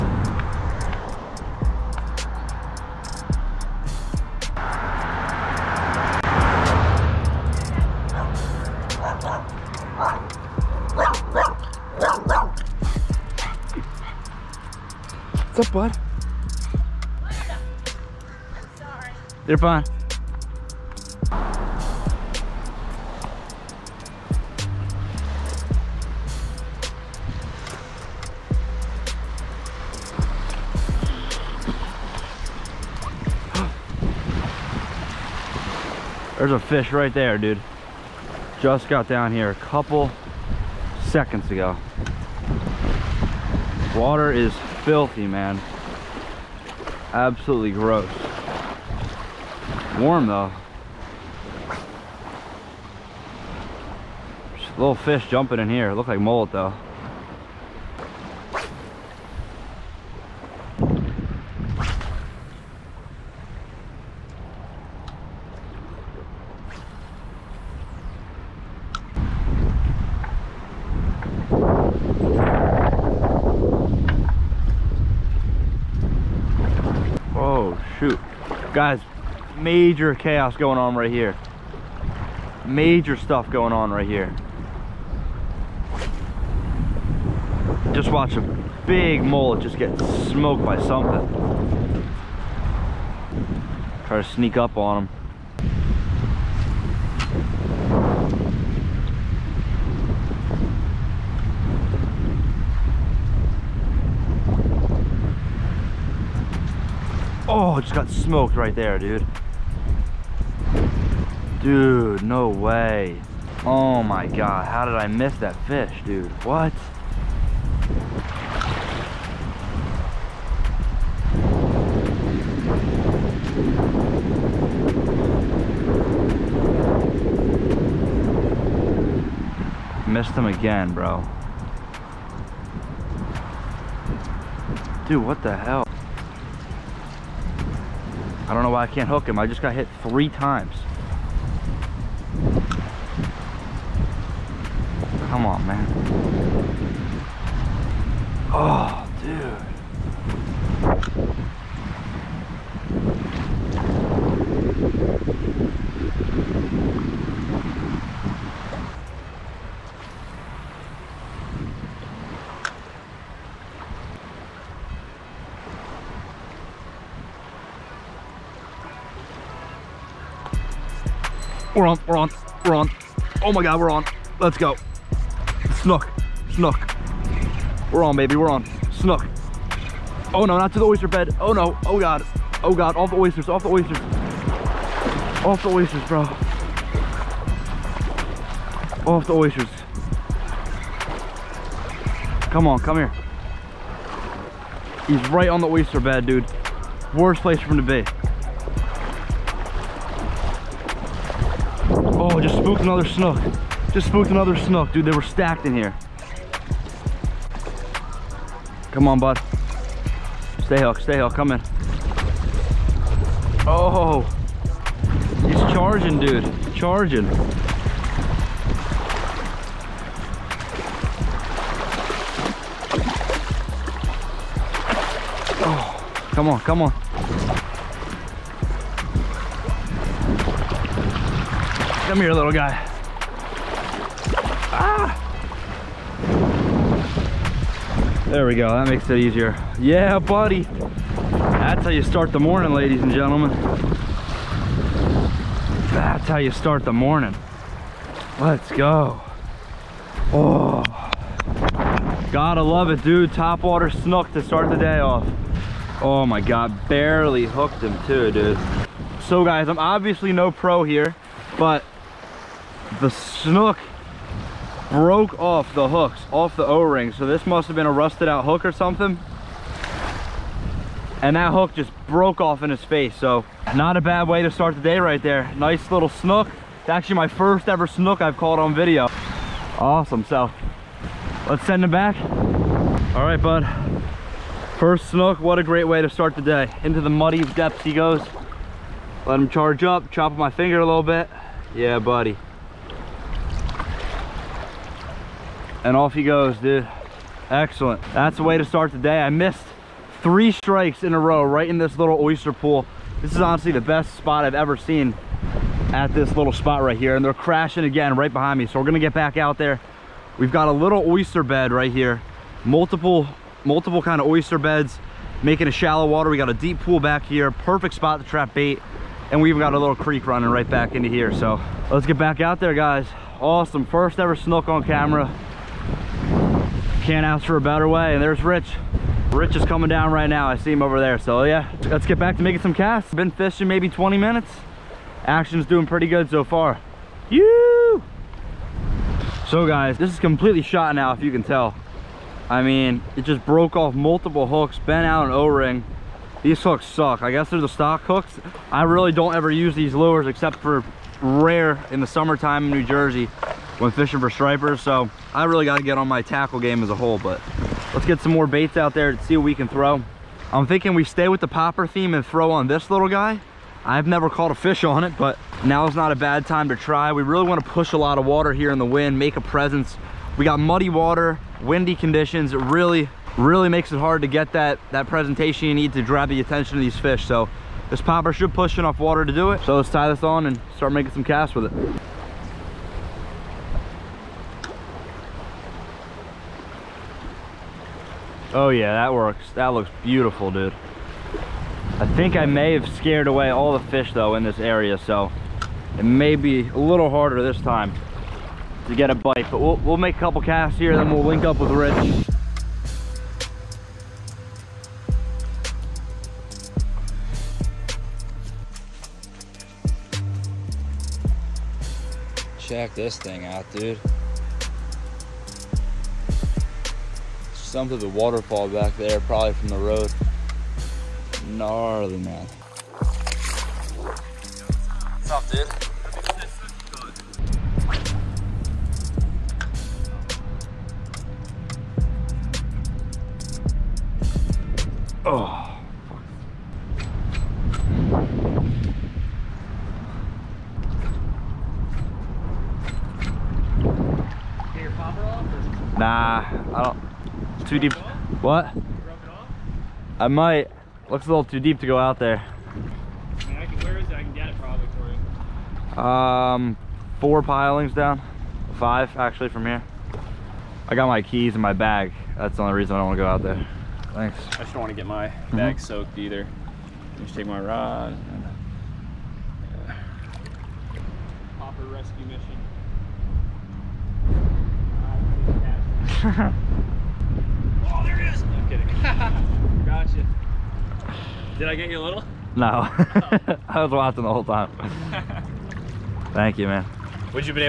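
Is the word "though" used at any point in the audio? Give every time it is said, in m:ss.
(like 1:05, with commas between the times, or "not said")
0:50, 0:56, 6:34.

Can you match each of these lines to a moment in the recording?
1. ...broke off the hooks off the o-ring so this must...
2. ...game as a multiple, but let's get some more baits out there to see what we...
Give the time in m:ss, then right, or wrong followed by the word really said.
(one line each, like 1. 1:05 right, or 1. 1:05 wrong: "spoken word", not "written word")
1. 4:24 right
2. 5:56 wrong: "whole", not "multiple".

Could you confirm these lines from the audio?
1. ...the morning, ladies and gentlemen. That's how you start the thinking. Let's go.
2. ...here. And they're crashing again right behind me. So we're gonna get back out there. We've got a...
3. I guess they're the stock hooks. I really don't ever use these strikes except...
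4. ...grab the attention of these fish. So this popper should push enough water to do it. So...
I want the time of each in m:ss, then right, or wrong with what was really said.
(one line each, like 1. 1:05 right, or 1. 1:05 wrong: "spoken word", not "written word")
1. 4:02 wrong: "morning", not "thinking"
2. 5:06 right
3. 5:47 wrong: "lures", not "strikes"
4. 6:16 right.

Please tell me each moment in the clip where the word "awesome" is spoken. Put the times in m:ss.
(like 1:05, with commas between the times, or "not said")
4:39, 5:23.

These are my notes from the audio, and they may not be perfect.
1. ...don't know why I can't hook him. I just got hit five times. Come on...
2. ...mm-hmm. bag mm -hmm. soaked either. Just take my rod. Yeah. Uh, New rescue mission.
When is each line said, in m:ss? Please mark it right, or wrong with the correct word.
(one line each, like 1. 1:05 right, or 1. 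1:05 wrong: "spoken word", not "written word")
1. 2:18 wrong: "three", not "five"
2. 7:45 wrong: "Popper", not "New".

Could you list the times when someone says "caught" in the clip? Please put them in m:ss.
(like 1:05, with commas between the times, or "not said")
4:38, 6:04.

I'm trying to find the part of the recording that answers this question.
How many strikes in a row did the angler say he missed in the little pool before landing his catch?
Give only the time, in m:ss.
5:00.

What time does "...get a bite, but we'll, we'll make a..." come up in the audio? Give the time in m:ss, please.
6:38.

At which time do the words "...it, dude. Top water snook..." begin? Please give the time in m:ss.
4:12.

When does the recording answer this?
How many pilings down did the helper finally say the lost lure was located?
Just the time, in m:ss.
7:38.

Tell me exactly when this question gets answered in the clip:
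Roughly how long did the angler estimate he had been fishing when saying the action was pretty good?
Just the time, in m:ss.
5:33.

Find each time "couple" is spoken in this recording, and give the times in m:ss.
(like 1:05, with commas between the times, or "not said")
0:39, 6:40.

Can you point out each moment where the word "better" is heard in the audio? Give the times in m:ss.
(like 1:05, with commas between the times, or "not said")
5:27.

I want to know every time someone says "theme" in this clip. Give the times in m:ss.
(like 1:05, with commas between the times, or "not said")
6:01.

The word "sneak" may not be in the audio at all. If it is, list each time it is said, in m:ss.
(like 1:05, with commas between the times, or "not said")
1:34.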